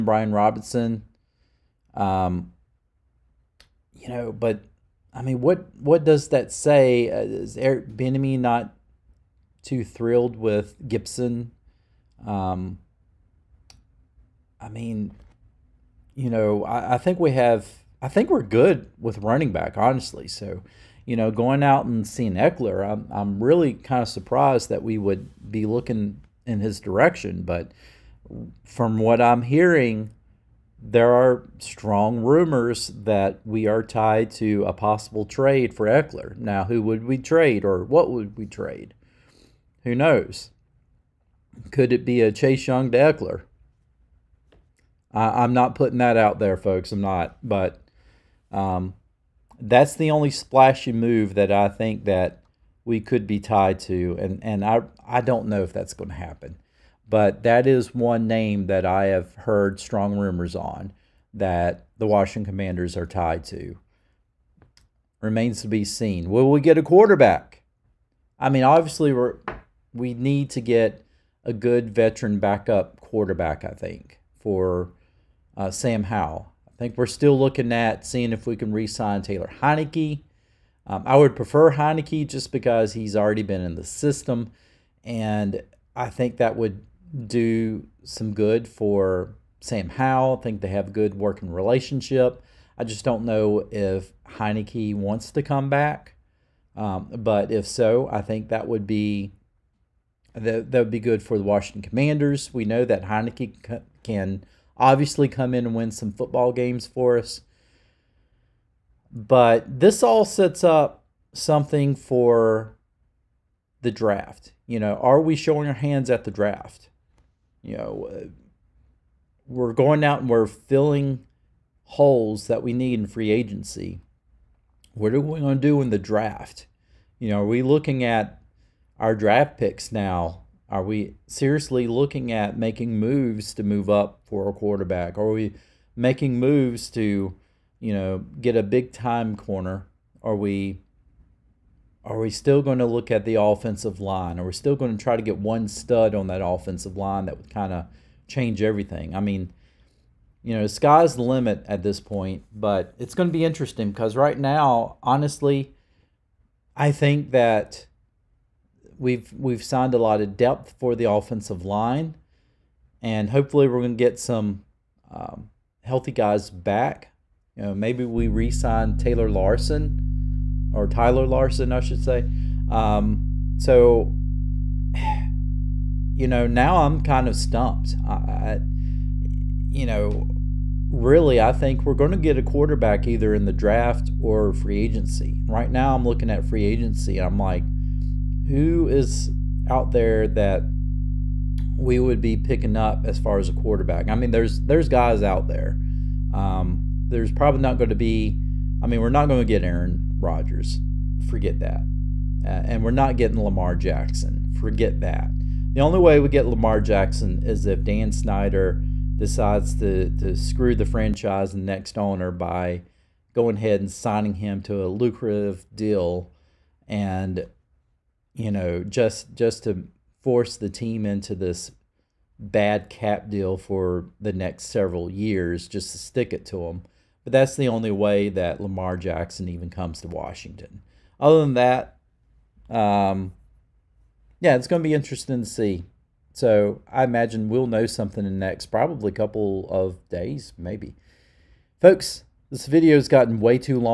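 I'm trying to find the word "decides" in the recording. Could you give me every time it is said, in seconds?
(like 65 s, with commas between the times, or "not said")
209 s.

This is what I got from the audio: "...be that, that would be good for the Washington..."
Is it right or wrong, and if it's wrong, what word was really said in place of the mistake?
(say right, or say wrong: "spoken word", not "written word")
right.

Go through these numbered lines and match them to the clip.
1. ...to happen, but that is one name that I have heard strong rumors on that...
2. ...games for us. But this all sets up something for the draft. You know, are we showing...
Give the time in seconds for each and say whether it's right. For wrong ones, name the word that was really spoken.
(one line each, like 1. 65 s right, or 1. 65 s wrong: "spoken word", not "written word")
1. 56 s right
2. 106 s right.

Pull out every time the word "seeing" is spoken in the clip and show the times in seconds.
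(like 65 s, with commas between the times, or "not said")
22 s, 78 s.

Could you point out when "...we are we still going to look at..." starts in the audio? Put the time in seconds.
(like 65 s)
140 s.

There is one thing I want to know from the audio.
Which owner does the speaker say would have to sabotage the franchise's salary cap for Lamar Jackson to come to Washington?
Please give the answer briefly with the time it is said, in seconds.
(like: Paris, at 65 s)
Dan Snyder, at 207 s.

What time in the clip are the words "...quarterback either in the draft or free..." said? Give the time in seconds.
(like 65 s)
182 s.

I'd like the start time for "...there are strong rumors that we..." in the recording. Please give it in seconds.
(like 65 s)
30 s.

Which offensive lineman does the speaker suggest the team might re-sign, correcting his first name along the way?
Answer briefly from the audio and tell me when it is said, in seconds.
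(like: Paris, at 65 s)
Tyler Larsen, at 170 s.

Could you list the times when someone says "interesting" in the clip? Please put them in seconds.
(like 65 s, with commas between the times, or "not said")
153 s, 234 s.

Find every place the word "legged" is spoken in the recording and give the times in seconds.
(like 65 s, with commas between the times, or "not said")
not said.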